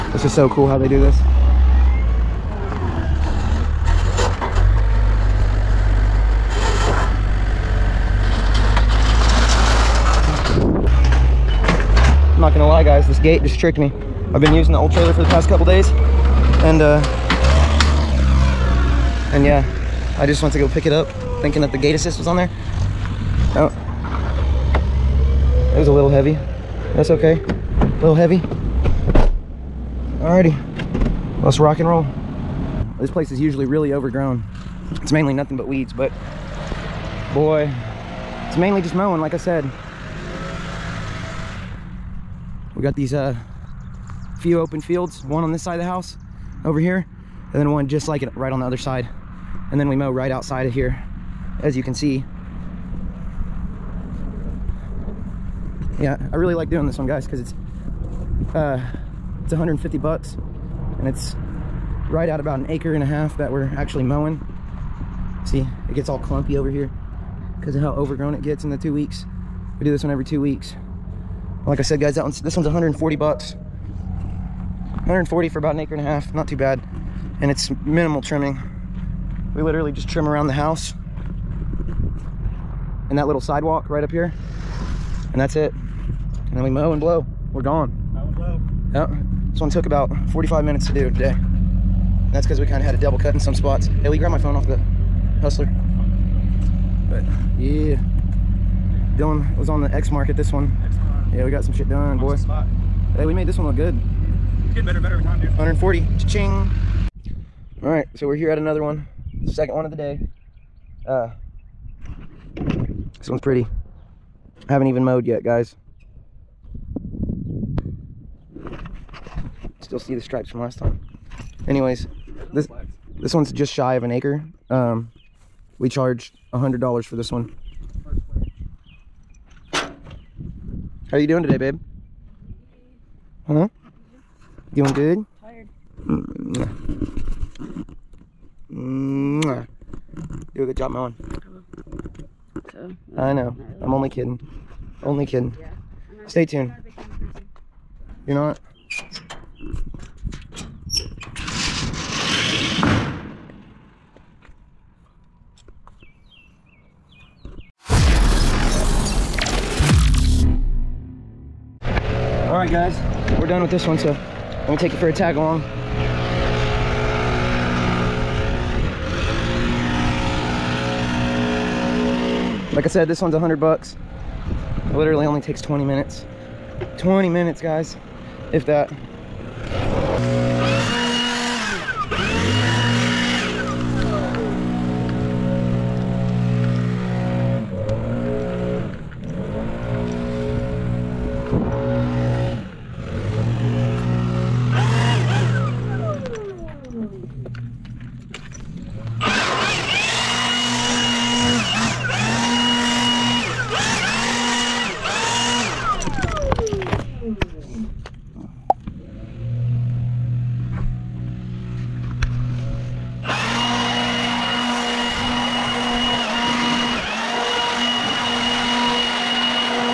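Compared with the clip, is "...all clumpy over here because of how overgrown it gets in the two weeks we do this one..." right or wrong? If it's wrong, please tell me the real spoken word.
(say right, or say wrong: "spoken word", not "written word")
right.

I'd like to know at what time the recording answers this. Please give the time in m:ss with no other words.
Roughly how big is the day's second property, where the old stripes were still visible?
2:03.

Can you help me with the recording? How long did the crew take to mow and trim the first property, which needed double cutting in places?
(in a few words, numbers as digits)
45 minutes.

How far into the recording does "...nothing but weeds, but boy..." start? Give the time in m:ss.
0:35.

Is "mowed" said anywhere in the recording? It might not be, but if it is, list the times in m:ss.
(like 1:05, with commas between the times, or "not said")
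1:55.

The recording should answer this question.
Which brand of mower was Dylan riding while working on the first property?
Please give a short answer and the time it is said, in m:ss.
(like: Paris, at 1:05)
Exmark, at 1:39.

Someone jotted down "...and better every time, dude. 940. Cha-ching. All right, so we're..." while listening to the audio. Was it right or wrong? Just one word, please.
wrong.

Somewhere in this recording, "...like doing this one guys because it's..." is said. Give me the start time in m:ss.
0:56.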